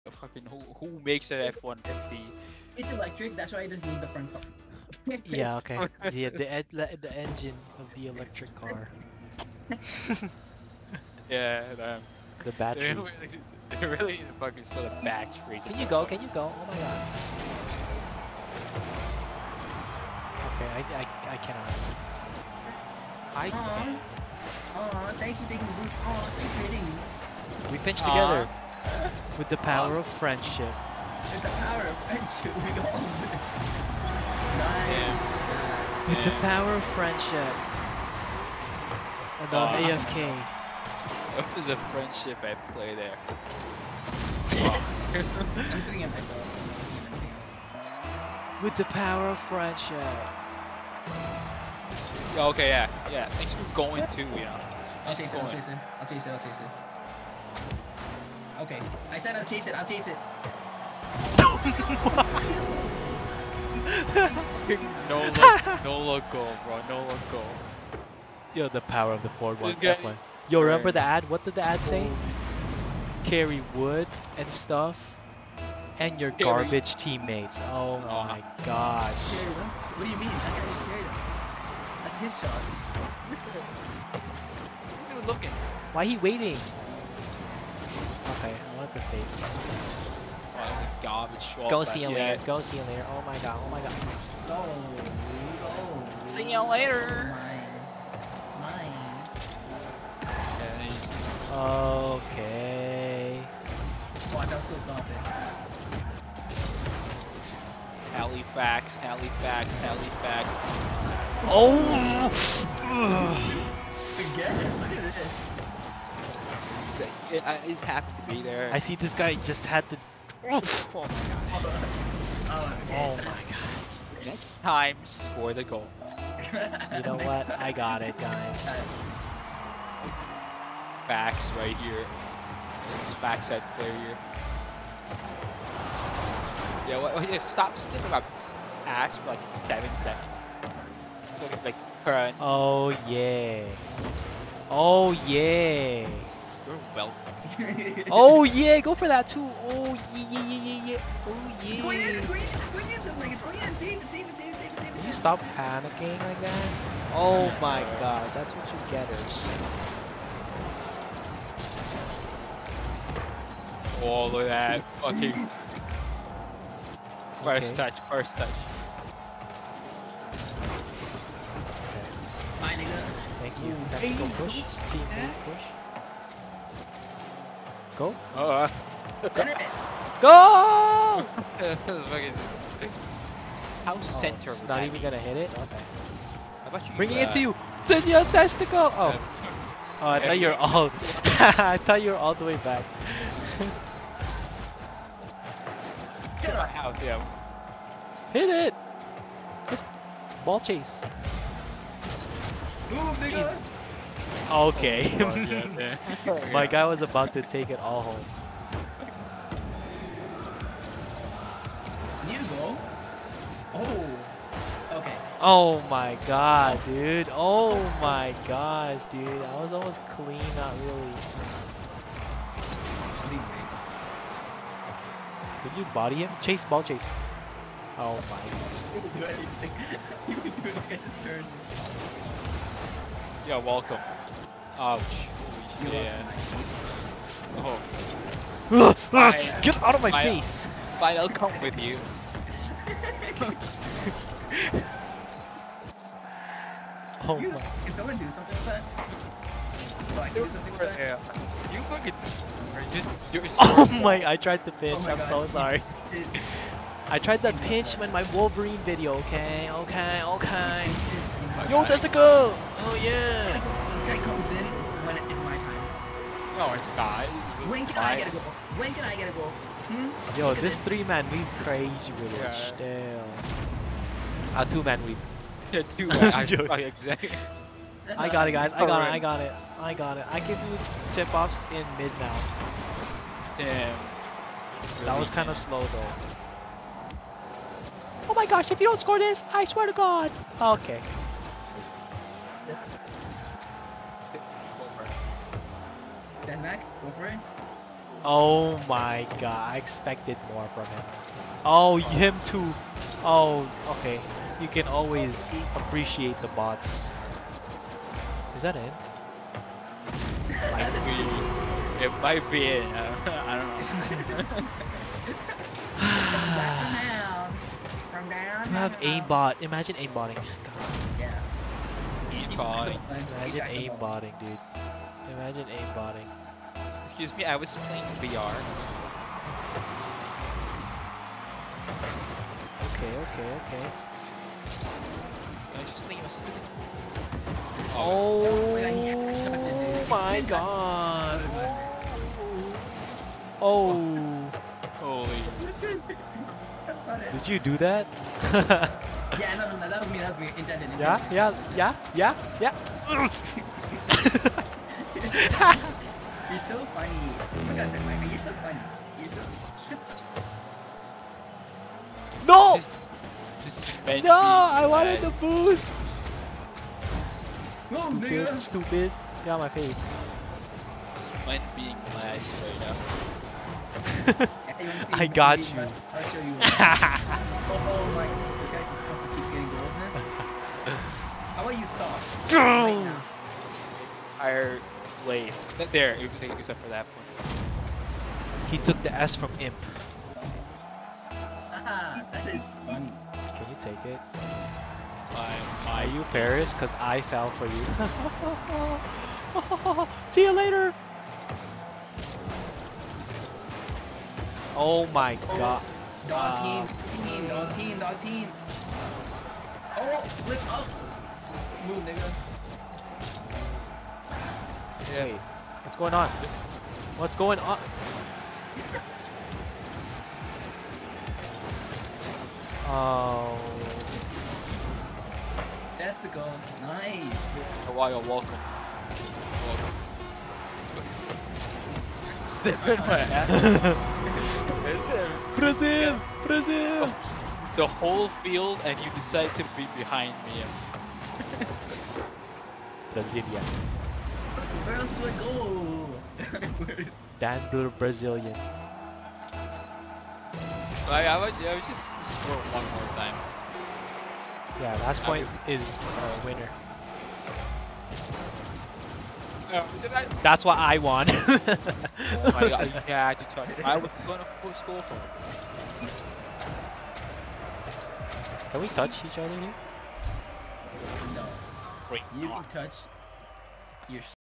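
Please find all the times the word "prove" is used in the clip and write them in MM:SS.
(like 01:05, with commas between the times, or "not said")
not said.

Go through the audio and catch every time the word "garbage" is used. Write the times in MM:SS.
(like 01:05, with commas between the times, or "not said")
01:16, 01:31.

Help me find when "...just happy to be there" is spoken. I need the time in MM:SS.
01:57.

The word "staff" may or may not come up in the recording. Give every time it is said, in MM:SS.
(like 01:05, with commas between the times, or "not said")
not said.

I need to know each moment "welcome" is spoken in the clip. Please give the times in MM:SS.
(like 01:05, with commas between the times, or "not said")
03:53, 07:08, 07:12.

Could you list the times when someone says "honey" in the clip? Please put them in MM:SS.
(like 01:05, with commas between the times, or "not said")
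not said.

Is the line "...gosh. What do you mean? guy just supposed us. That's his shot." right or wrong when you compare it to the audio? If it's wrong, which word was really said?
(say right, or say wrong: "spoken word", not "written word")
wrong: "carried", not "supposed".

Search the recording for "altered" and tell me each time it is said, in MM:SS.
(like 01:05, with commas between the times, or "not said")
not said.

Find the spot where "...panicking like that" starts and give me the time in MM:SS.
02:35.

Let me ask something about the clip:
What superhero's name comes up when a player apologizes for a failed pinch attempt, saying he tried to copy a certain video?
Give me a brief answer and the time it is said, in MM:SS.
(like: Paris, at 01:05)
Wolverine, at 04:18.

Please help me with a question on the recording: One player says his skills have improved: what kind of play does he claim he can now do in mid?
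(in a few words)
tip-offs.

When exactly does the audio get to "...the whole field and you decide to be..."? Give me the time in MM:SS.
07:17.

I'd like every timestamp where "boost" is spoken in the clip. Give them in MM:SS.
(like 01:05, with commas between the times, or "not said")
00:25, 06:05.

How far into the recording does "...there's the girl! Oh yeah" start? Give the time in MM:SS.
04:21.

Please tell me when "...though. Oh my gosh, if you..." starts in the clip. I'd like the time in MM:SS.
04:45.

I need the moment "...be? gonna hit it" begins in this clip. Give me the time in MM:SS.
03:04.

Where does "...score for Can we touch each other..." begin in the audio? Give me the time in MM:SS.
07:44.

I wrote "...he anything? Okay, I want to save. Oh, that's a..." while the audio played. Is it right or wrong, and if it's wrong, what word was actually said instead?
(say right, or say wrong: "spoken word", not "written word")
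wrong: "waiting", not "anything".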